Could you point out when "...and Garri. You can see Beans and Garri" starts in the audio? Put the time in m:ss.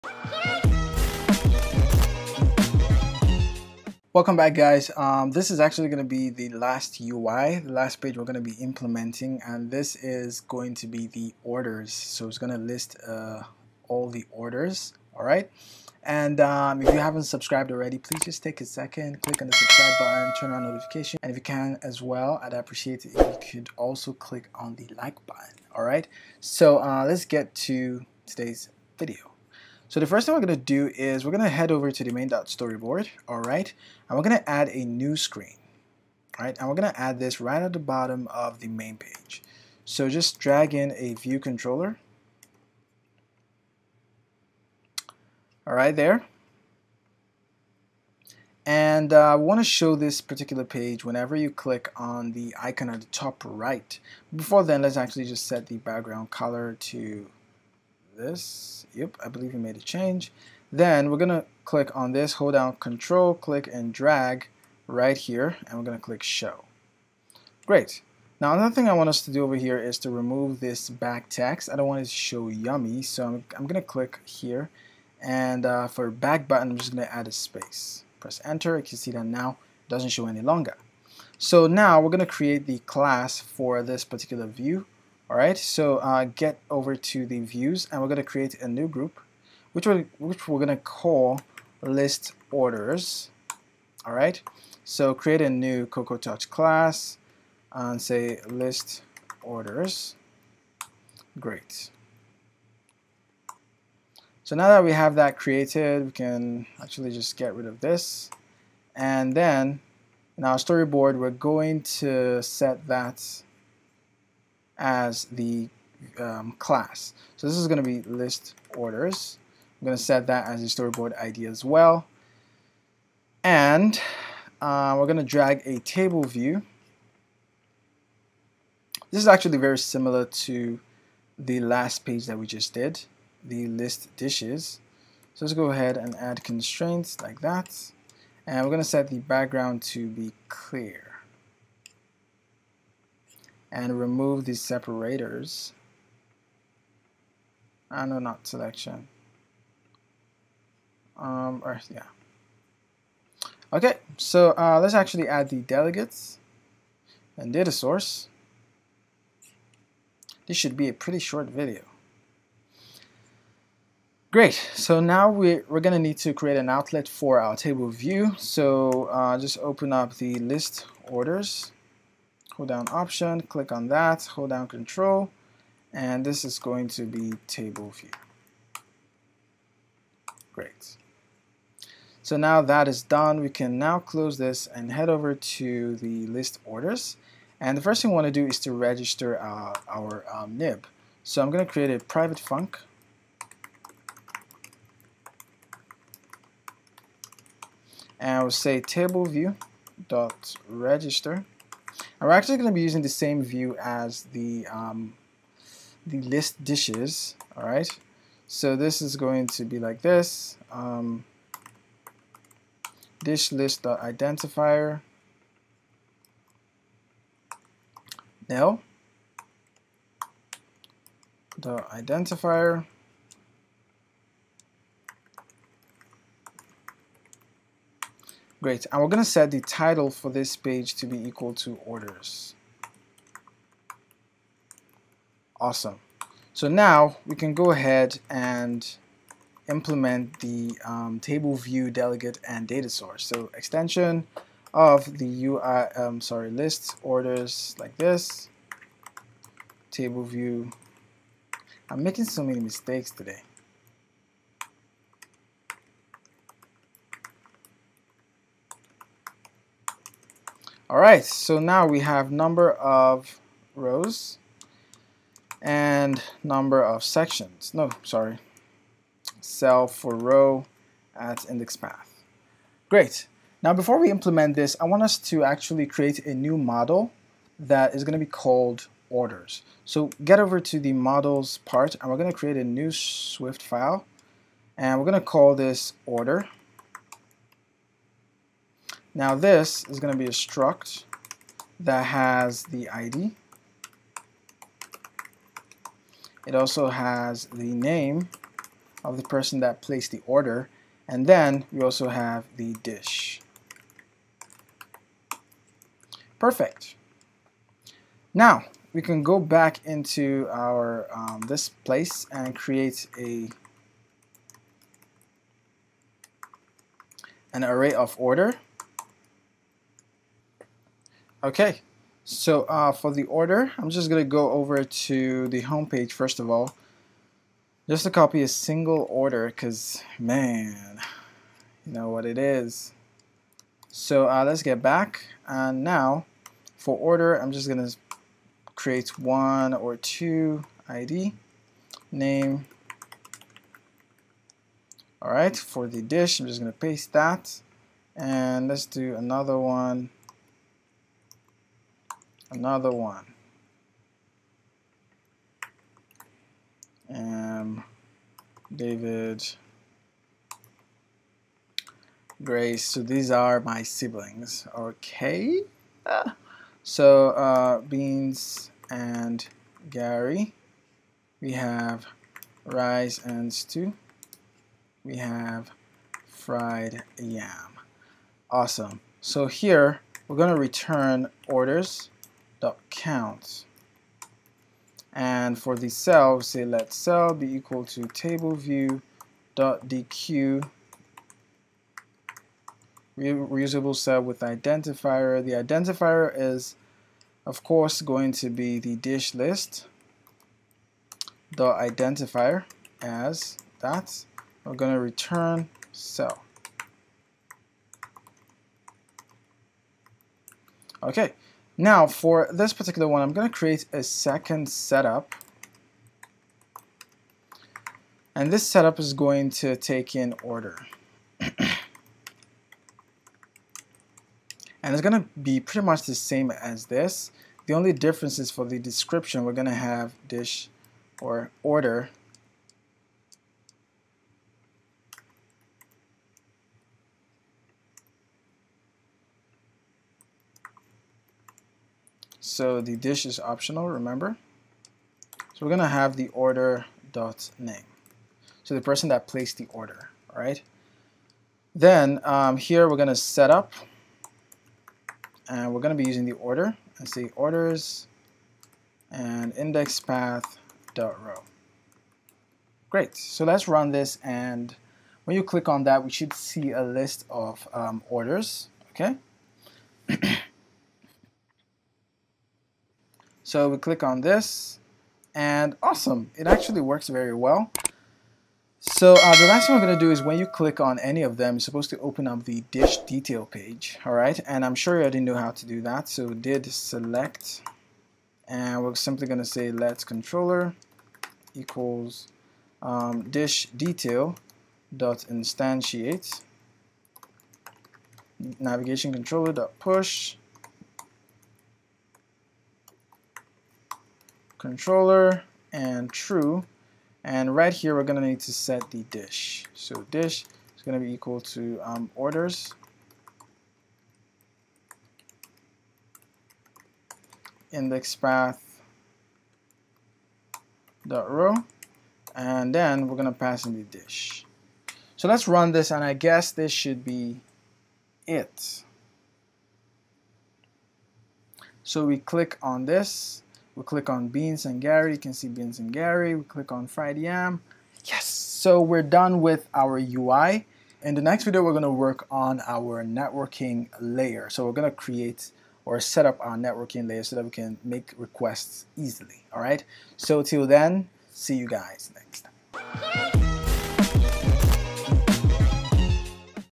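8:54.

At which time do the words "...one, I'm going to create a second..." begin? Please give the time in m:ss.
6:53.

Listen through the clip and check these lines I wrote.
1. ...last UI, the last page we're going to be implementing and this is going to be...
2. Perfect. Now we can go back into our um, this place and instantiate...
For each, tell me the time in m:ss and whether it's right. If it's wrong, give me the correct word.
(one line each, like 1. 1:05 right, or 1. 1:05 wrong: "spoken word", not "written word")
1. 0:06 right
2. 5:06 wrong: "create", not "instantiate".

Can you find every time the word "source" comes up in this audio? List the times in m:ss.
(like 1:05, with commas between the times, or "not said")
2:37, 4:02.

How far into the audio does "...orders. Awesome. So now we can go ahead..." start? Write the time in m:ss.
3:51.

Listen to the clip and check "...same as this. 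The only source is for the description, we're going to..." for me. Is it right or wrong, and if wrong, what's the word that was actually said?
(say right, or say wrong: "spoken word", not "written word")
wrong: "difference", not "source".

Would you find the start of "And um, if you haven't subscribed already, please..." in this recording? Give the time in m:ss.
0:16.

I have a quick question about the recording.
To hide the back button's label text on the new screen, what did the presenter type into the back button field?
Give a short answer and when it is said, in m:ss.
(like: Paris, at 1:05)
a space, at 1:16.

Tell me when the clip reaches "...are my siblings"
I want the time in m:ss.
6:03.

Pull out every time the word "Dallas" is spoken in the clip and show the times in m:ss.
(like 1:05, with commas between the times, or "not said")
not said.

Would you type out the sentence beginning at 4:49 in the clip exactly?
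Now this is going to be a struct that has the ID.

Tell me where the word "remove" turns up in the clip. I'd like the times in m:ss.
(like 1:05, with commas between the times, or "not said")
1:10, 2:23.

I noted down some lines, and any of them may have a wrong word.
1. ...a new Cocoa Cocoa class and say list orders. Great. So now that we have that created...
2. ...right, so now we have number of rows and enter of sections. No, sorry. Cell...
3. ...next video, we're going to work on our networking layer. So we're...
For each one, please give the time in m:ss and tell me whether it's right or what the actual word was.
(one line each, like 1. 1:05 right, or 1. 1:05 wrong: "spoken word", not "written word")
1. 1:35 wrong: "Touch", not "Cocoa"
2. 4:20 wrong: "number", not "enter"
3. 9:01 right.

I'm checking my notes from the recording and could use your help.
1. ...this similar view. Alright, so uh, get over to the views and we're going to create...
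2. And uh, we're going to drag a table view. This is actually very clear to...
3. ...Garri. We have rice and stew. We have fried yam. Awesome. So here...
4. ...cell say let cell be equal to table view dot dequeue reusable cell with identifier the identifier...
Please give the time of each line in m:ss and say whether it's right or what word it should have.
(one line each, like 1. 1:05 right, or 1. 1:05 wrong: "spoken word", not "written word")
1. 1:23 wrong: "particular", not "similar"
2. 2:03 wrong: "similar", not "clear"
3. 6:09 right
4. 6:25 right.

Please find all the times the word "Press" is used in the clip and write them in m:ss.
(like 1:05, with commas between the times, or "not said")
1:18.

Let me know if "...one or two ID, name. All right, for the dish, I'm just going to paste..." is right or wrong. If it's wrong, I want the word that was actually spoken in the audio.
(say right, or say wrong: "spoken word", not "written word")
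right.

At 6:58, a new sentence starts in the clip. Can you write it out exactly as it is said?
And this setup is going to take in order.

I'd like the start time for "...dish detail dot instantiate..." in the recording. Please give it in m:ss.
8:13.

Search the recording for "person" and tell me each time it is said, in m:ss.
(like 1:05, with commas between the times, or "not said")
4:59, 7:28.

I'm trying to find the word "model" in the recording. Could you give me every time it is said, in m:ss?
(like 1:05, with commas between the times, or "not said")
4:36, 4:40.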